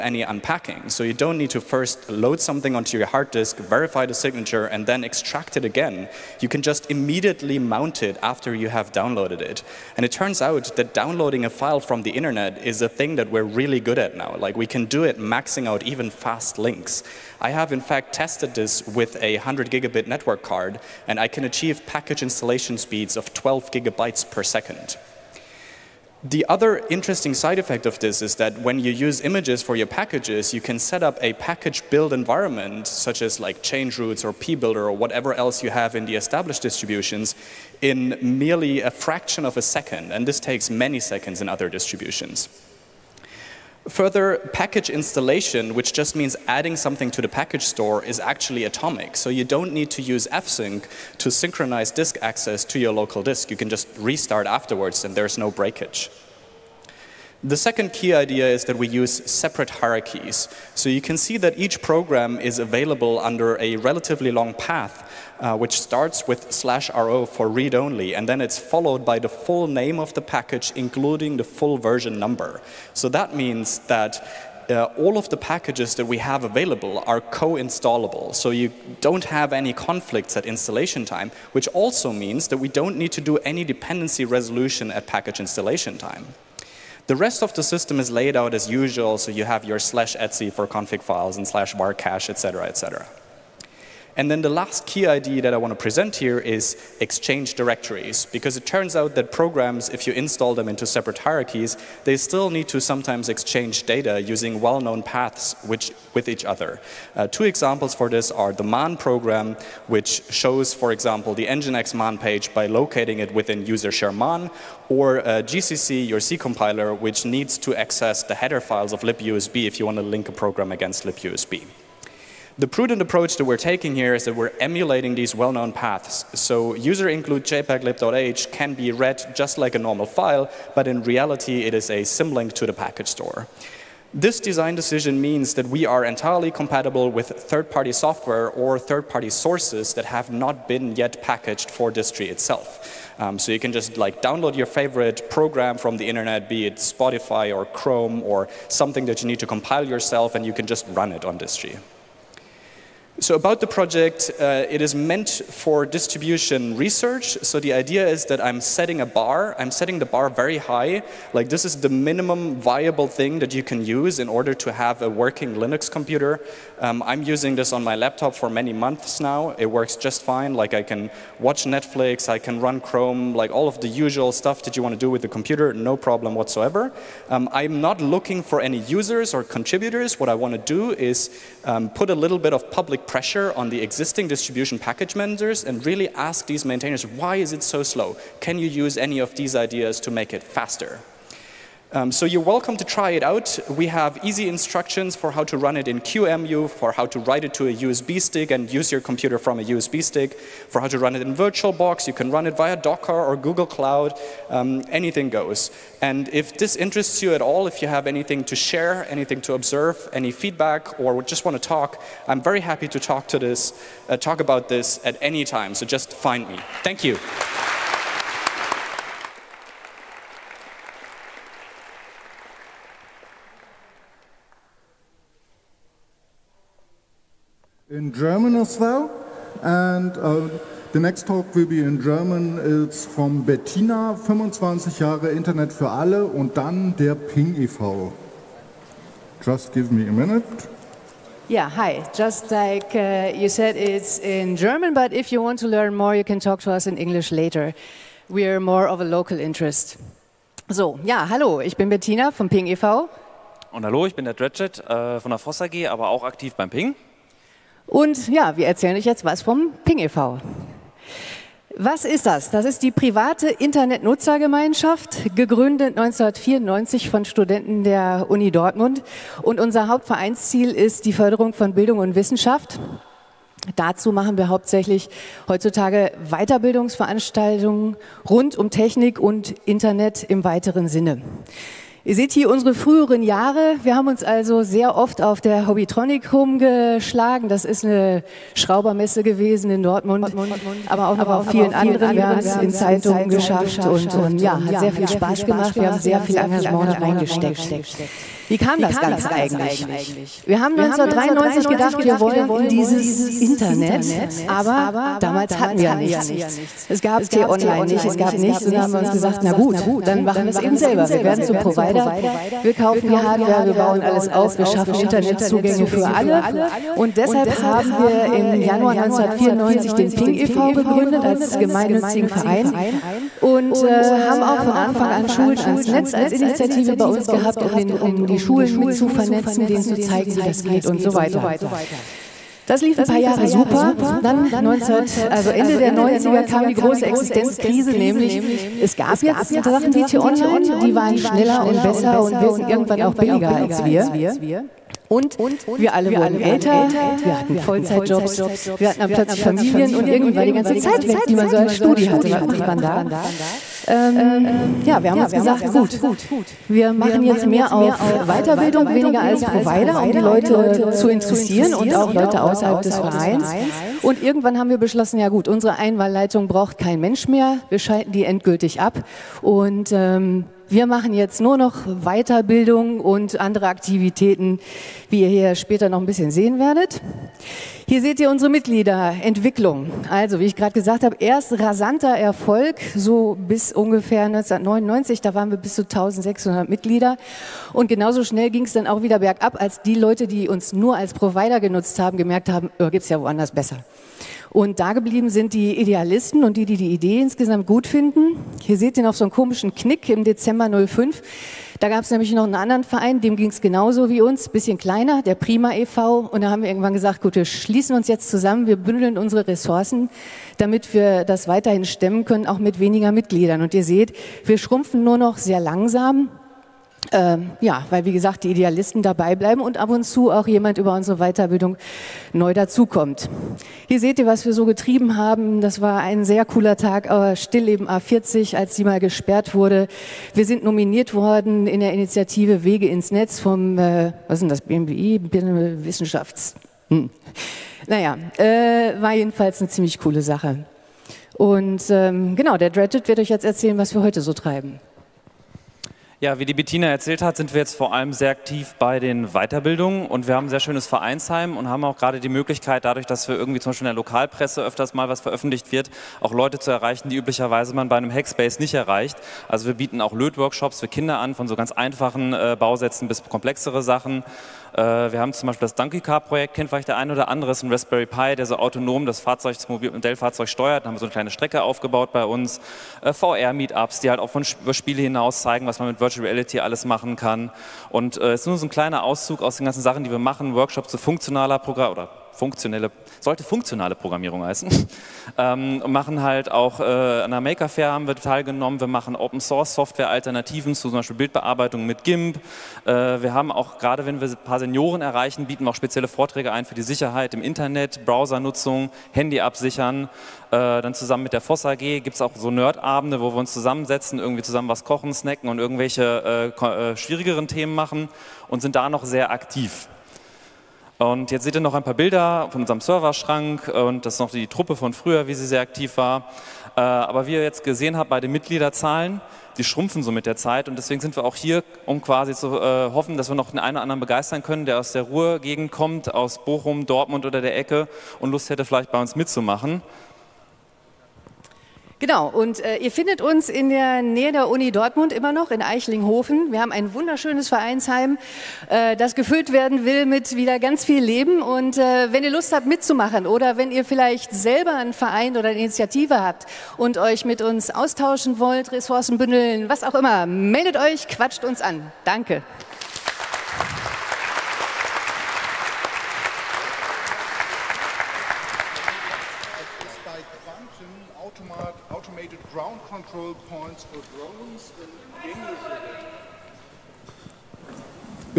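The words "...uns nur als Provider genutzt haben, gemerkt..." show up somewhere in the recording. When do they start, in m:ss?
6:30.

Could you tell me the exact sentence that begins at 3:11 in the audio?
Um, so you're welcome to try it out.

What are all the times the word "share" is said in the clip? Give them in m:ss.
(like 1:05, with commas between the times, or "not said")
1:53, 3:28.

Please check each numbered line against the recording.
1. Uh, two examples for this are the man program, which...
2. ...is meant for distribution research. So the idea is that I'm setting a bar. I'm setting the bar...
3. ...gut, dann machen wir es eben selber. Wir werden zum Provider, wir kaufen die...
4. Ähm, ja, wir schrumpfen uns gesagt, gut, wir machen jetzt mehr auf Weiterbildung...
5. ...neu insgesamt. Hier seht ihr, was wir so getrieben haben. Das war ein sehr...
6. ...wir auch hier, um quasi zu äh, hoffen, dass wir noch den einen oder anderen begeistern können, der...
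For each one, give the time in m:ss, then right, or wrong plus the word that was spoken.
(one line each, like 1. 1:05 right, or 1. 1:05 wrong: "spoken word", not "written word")
1. 1:47 right
2. 2:34 right
3. 5:09 right
4. 5:53 wrong: "haben", not "schrumpfen"
5. 7:02 wrong: "dazukommt", not "insgesamt"
6. 8:41 right.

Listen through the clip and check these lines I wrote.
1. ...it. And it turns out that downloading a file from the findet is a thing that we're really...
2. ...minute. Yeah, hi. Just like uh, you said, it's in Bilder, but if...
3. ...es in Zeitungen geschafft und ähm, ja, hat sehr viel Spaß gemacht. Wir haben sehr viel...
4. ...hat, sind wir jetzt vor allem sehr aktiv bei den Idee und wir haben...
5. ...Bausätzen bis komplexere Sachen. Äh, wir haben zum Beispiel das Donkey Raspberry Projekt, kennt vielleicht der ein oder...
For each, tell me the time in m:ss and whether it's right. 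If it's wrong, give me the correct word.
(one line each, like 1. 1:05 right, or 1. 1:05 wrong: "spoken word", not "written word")
1. 0:09 wrong: "internet", not "findet"
2. 4:00 wrong: "German", not "Bilder"
3. 4:52 right
4. 7:27 wrong: "Weiterbildungen", not "Idee"
5. 7:42 wrong: "Car", not "Raspberry".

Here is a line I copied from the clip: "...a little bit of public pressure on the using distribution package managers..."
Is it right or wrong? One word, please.
wrong.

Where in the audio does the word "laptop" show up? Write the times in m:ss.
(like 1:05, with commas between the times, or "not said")
2:47.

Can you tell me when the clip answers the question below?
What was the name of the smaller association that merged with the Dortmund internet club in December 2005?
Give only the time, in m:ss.
6:45.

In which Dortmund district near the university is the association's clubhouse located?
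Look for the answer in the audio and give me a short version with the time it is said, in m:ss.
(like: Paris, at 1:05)
Eichlinghofen, at 8:55.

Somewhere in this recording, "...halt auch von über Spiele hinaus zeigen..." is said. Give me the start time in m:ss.
7:54.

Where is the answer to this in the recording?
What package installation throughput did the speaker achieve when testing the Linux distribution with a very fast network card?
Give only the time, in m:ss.
0:23.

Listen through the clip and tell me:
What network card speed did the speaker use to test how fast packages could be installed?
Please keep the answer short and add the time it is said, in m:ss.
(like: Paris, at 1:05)
100 gigabit, at 0:19.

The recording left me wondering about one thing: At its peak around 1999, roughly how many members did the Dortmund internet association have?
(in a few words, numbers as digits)
1600.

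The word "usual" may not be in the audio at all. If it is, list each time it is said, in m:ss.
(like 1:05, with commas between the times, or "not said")
1:28, 2:53.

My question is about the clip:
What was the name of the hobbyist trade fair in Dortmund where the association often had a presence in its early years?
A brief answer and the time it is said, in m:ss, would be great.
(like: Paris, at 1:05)
Hobbytronic, at 4:45.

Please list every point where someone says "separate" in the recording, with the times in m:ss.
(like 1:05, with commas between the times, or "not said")
0:59, 1:40.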